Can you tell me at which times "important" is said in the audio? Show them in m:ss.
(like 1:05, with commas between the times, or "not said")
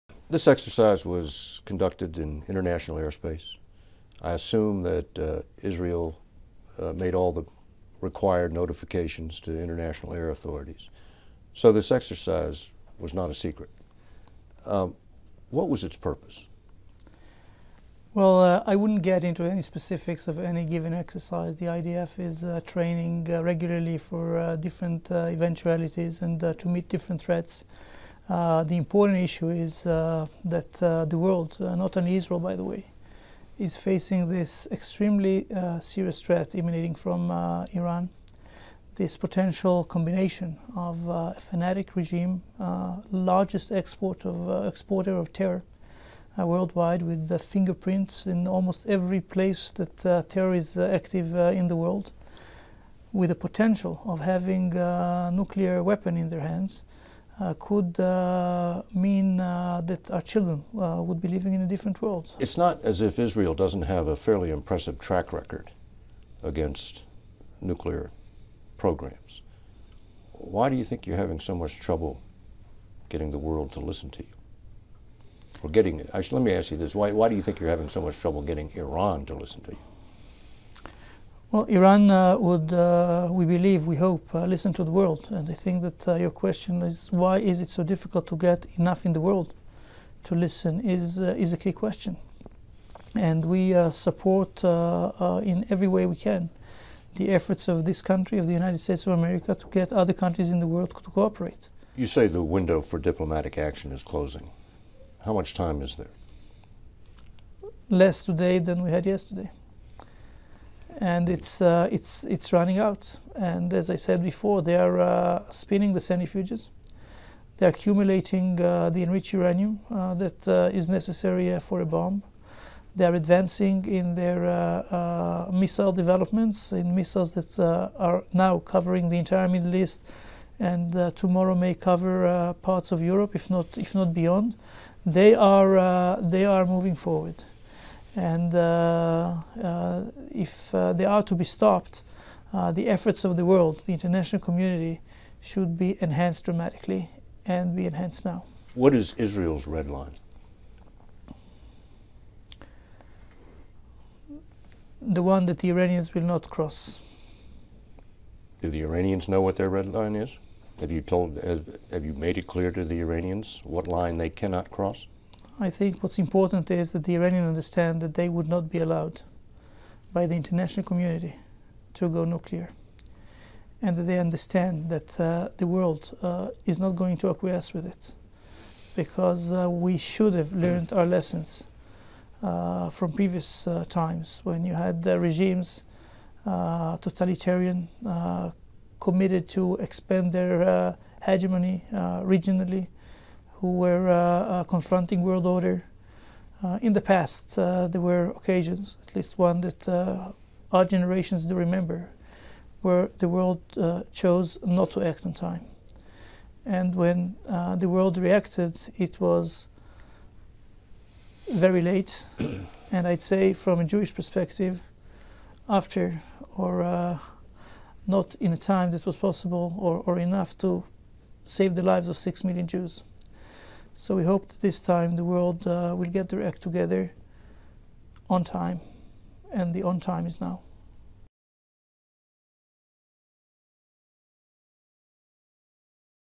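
0:28, 2:46.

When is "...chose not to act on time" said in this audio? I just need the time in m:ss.
3:24.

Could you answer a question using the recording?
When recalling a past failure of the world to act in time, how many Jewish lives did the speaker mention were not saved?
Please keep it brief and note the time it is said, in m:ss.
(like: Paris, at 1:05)
6 million, at 3:42.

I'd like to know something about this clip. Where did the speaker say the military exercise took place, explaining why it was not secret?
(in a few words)
International airspace.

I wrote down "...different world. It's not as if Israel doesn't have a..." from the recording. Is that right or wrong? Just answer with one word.
right.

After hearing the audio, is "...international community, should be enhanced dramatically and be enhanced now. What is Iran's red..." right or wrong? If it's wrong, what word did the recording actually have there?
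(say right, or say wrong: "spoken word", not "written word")
wrong: "Israel", not "Iran".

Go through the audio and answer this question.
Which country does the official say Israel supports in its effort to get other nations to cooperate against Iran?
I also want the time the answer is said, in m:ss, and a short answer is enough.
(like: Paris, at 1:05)
United States of America, at 1:38.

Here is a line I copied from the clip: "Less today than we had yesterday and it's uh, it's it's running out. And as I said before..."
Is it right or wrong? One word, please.
right.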